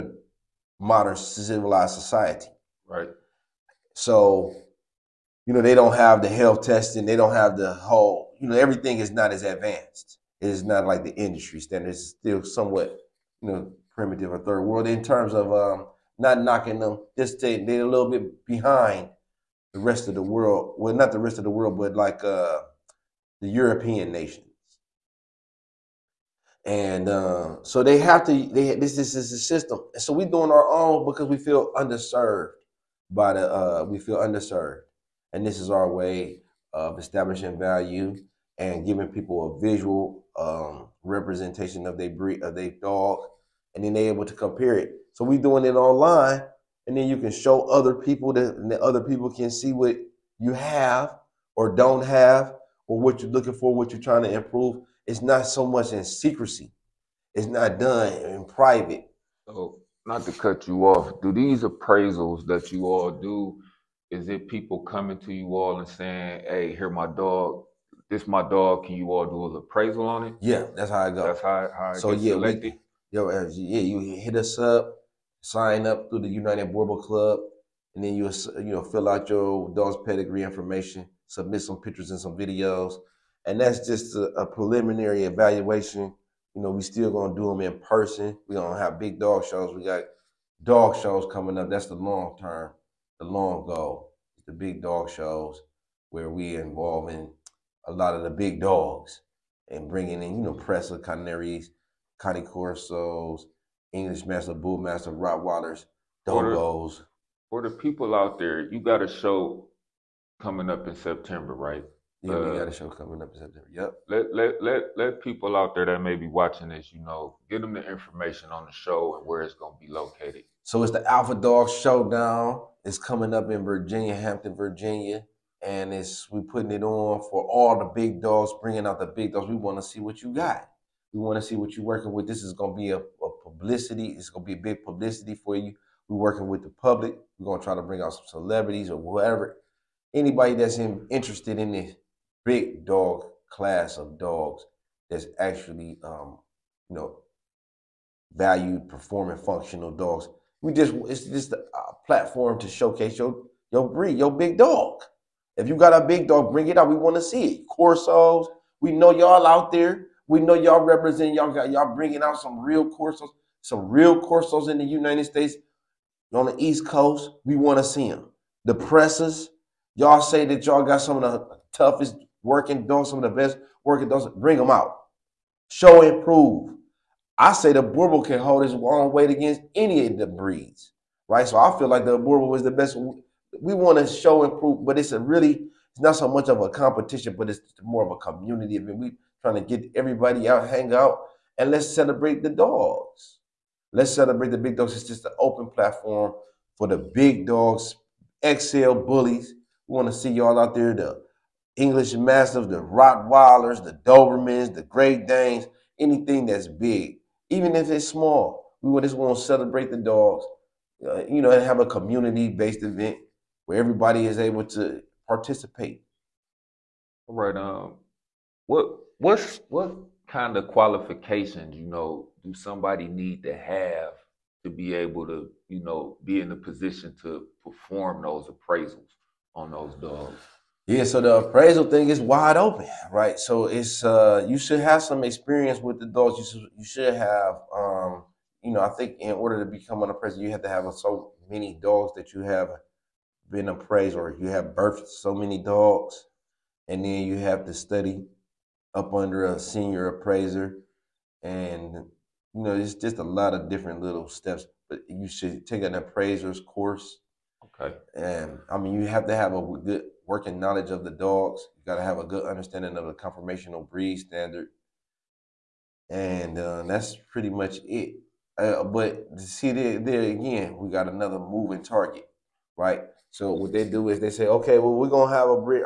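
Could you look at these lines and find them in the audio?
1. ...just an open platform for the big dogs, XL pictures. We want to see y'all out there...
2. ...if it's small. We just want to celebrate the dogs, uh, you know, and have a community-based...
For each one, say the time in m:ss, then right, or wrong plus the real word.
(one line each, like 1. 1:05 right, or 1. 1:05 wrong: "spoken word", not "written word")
1. 3:15 wrong: "bullies", not "pictures"
2. 3:27 right.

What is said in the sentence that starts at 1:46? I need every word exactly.
For, the, for the people out there, you got a show coming up in September, right?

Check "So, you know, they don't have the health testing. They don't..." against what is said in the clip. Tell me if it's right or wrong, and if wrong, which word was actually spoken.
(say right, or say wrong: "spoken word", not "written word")
right.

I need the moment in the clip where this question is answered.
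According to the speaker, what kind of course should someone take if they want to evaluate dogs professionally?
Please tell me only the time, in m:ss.
4:15.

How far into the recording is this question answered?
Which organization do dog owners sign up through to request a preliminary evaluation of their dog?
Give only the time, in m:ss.
1:16.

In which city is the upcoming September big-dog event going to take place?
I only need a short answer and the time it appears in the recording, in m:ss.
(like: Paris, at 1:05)
Hampton, Virginia, at 2:04.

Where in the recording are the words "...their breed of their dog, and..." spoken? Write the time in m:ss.
0:41.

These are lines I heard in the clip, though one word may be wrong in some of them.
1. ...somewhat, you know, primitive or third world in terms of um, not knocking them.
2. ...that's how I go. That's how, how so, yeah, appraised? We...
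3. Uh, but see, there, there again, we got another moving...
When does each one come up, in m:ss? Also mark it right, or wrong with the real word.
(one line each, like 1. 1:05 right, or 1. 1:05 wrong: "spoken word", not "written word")
1. 0:12 right
2. 1:10 wrong: "selected", not "appraised"
3. 4:28 right.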